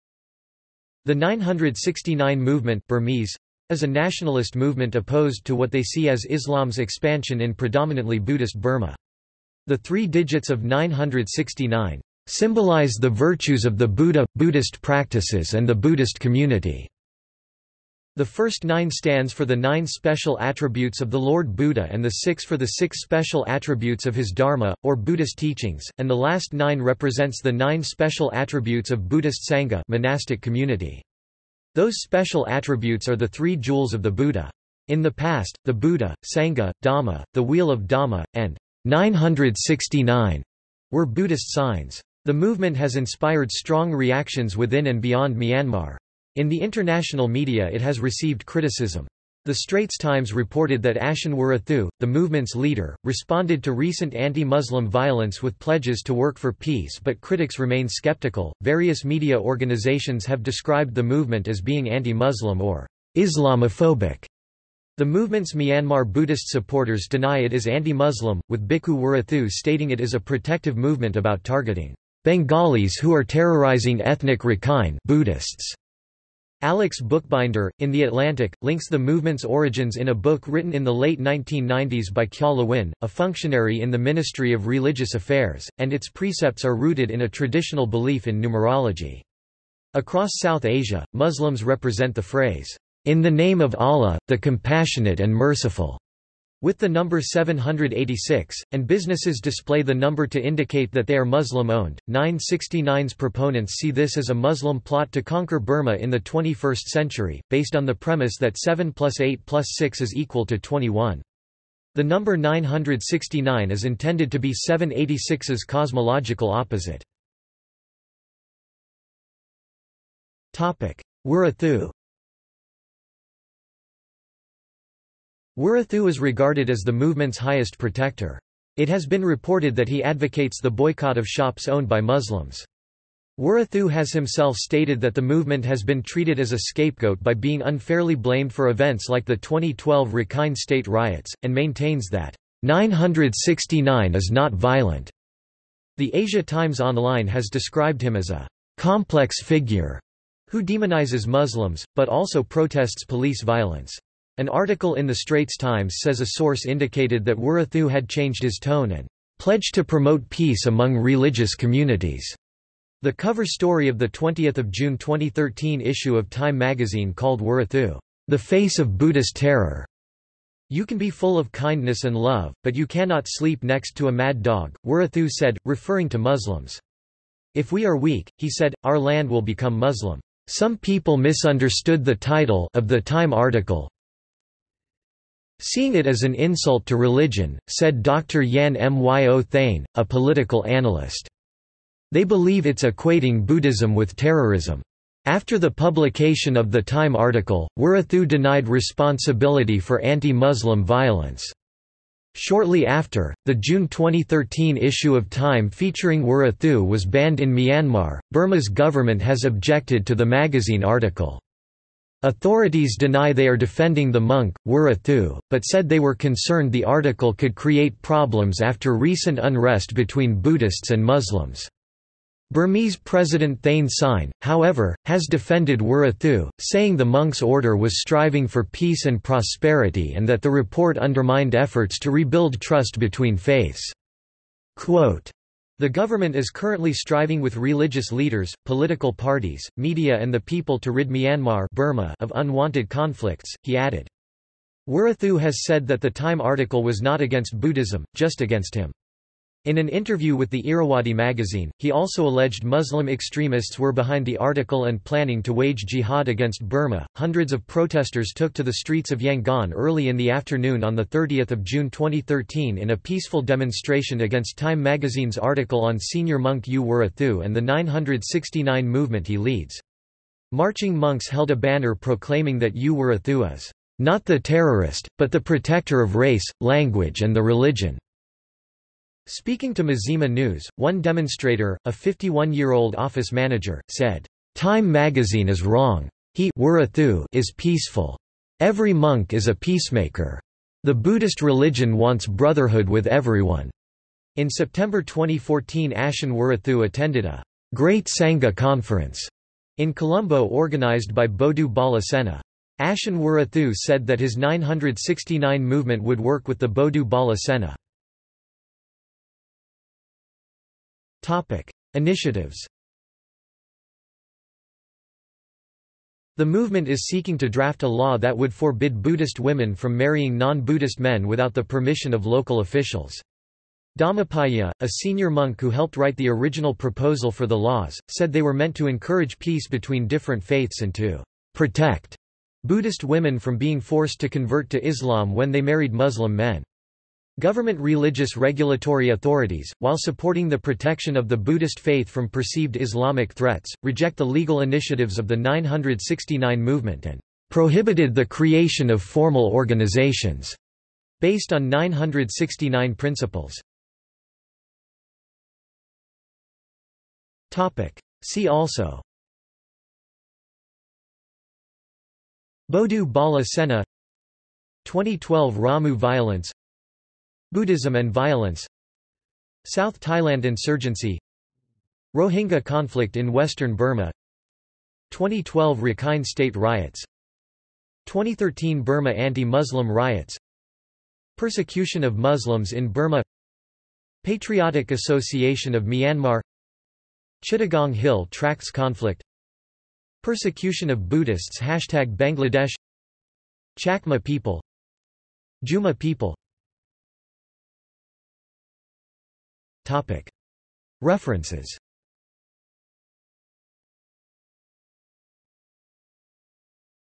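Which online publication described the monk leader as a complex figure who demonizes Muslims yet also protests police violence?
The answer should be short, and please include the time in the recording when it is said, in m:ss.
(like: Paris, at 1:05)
Asia Times Online, at 2:26.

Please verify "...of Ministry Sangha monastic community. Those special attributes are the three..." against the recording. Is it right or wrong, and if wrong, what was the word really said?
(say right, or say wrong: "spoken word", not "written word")
wrong: "Buddhist", not "Ministry".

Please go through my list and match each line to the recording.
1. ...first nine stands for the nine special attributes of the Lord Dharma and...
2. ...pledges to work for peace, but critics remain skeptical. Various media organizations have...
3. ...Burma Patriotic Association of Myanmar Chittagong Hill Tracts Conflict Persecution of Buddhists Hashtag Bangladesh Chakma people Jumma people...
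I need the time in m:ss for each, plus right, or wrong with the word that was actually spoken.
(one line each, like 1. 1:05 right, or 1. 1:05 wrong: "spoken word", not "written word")
1. 0:18 wrong: "Buddha", not "Dharma"
2. 0:55 right
3. 6:22 right.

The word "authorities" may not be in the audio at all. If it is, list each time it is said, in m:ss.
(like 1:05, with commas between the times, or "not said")
3:32, 5:39.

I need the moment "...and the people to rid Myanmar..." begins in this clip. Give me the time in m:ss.
4:00.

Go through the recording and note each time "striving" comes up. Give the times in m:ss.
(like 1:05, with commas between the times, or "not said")
3:47, 3:56.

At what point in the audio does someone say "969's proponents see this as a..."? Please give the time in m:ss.
1:42.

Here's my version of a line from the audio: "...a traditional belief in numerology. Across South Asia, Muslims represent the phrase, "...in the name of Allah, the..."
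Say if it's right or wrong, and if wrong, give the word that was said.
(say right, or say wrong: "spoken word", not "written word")
right.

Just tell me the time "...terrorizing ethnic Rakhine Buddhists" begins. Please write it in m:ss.
1:13.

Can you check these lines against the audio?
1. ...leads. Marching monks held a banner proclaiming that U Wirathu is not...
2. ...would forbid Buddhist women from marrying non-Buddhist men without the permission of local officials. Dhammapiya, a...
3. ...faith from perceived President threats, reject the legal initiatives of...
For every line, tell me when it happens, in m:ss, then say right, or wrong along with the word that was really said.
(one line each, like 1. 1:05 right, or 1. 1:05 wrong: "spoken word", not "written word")
1. 4:29 right
2. 5:18 right
3. 5:41 wrong: "Islamic", not "President".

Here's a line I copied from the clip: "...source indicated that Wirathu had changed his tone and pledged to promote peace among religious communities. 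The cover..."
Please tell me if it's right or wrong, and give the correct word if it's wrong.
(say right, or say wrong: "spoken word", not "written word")
right.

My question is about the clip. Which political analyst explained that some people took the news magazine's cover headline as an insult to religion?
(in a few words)
Dr. Yan Myo Thane.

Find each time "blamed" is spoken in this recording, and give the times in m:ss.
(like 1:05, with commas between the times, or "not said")
2:18.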